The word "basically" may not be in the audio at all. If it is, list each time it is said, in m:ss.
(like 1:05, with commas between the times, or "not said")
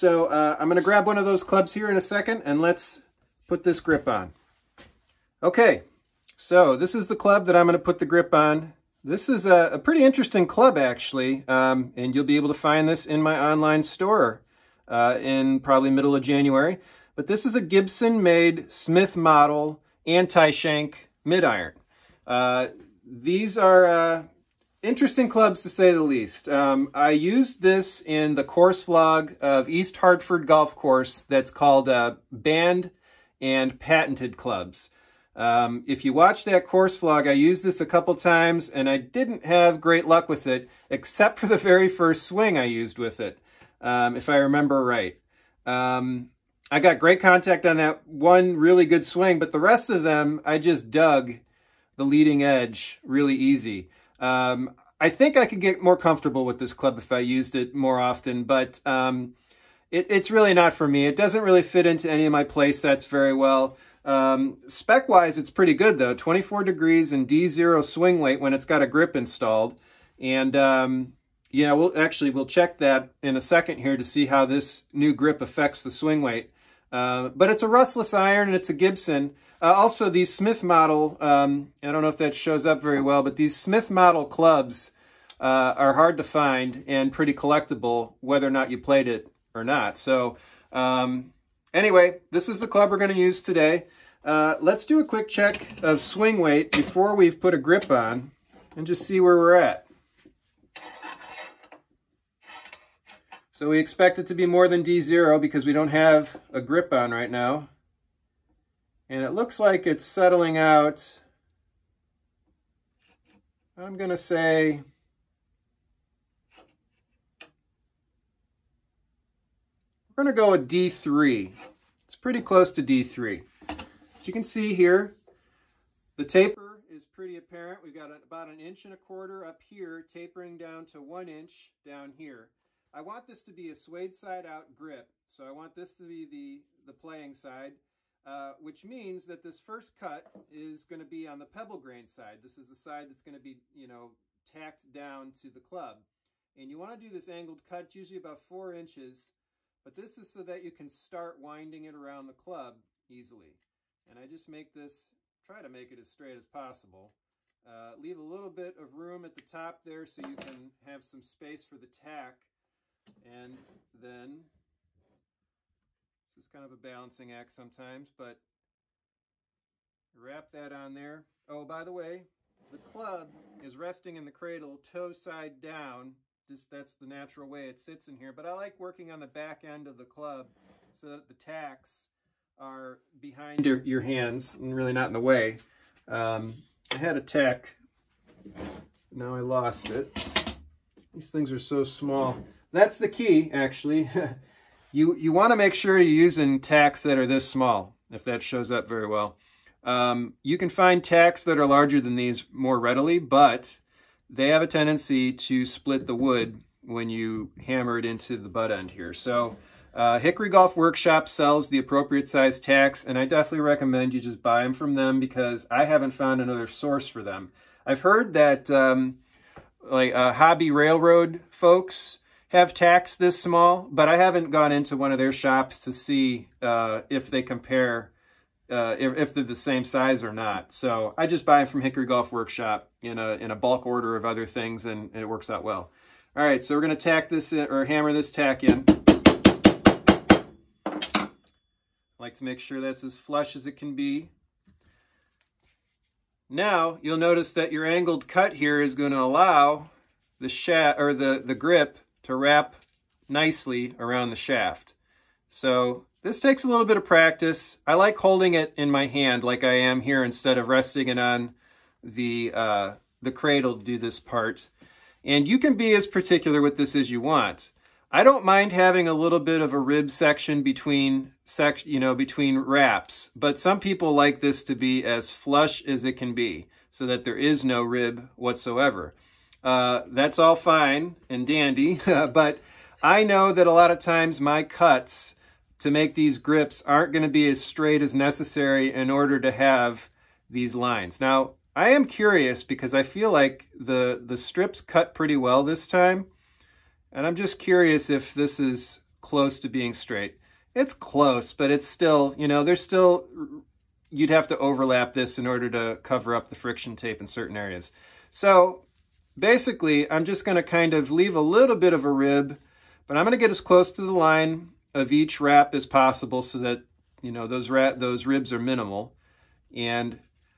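5:09.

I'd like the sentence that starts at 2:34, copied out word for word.
And I just make this, try to make it as straight as possible.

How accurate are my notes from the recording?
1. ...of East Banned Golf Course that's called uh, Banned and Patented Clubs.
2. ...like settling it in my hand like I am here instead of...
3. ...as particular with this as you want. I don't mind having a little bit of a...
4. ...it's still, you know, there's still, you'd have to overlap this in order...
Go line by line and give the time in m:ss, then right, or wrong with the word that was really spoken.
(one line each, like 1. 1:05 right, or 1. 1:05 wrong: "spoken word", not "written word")
1. 0:29 wrong: "Hartford", not "Banned"
2. 4:17 wrong: "holding", not "settling"
3. 4:25 right
4. 5:01 right.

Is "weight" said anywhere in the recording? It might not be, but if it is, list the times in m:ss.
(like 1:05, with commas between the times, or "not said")
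1:08, 1:16, 1:36.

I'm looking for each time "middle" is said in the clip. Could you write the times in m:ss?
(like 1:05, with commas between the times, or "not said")
0:15.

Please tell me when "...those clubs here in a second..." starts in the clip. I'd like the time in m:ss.
0:01.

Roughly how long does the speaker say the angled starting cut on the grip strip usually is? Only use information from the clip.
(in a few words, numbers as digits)
4 inches.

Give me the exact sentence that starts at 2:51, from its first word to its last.
Oh, by the way, the club is resting in the cradle, toe side down.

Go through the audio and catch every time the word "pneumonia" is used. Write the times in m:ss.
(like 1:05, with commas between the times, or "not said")
not said.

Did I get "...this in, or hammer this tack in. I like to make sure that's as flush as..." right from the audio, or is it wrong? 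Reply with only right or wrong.
right.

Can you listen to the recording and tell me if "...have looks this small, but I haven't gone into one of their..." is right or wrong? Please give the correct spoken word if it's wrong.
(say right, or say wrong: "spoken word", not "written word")
wrong: "tacks", not "looks".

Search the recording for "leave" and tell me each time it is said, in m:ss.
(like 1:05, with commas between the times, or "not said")
2:37, 5:11.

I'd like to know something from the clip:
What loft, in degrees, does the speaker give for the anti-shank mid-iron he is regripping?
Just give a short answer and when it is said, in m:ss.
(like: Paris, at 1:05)
24 degrees, at 1:06.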